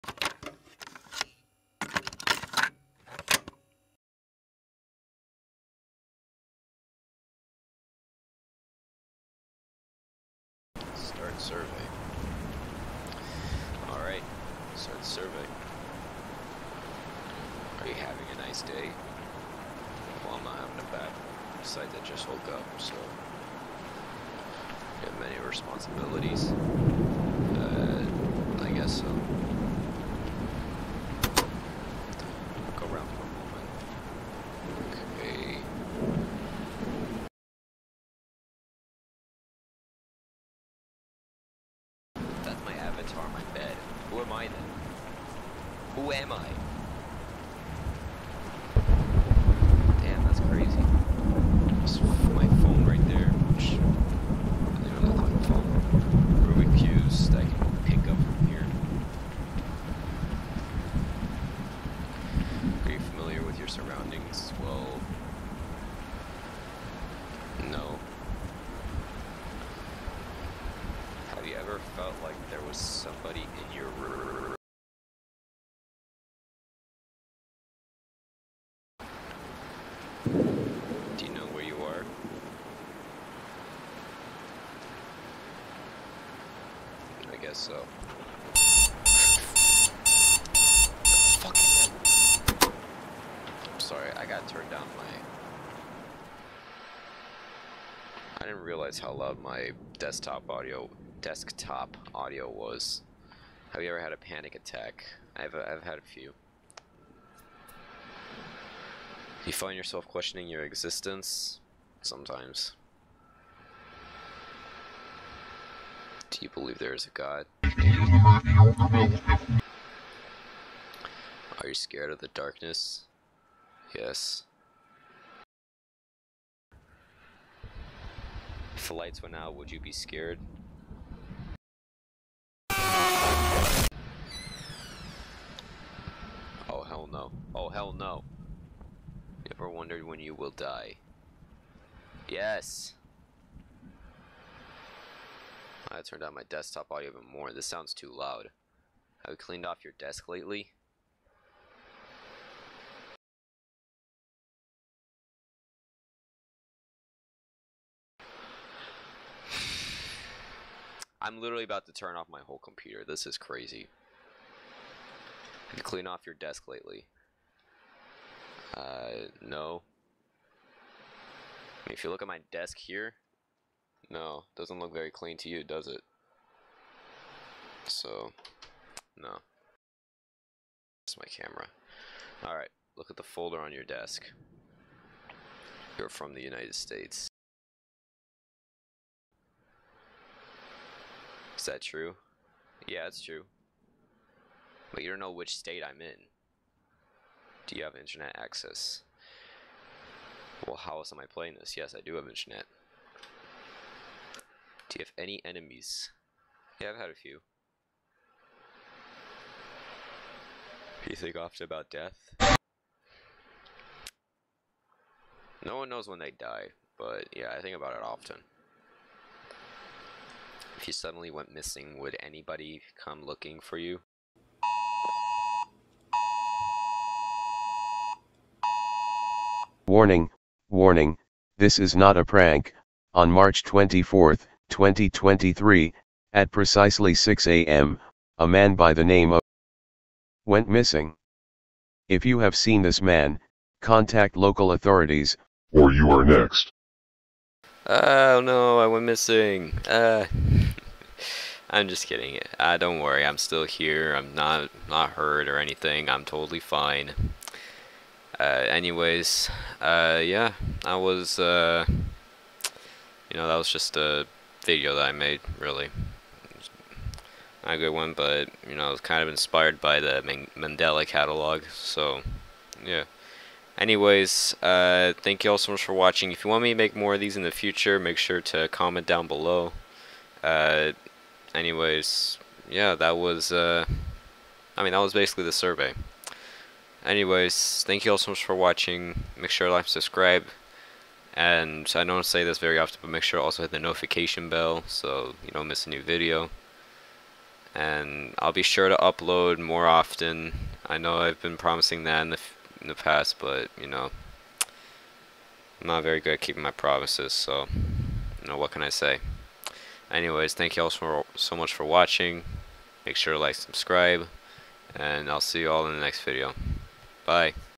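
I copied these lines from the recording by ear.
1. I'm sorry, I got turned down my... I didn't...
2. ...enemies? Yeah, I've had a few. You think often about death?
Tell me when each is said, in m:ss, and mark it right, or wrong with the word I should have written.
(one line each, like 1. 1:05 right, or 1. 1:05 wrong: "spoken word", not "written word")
1. 1:33 right
2. 3:25 right.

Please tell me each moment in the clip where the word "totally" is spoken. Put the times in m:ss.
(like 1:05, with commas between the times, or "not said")
4:16.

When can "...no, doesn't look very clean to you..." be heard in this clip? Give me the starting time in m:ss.
2:54.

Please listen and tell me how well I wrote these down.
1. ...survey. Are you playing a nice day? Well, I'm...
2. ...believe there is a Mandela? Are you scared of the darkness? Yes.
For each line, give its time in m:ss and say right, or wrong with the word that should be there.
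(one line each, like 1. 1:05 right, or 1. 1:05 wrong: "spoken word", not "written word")
1. 0:15 wrong: "having", not "playing"
2. 1:56 wrong: "God", not "Mandela".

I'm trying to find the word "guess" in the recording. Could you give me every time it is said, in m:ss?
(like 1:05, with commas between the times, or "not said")
0:28, 1:27.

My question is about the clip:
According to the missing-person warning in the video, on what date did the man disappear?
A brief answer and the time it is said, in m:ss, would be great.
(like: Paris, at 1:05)
March 24, 2023, at 3:53.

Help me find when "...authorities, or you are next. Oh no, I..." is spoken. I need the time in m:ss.
4:04.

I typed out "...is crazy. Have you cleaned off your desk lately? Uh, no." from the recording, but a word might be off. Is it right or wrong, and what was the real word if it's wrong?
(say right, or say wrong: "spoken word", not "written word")
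right.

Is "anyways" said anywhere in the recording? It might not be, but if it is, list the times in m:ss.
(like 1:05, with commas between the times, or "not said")
4:18, 4:33, 4:41, 4:47, 5:10.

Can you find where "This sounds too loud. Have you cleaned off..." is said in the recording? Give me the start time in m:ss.
2:27.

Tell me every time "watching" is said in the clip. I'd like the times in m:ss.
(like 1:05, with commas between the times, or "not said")
4:35, 4:48, 5:11.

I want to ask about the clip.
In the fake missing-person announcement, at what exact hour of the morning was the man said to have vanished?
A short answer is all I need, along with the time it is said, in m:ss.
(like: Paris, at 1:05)
6 a.m., at 3:57.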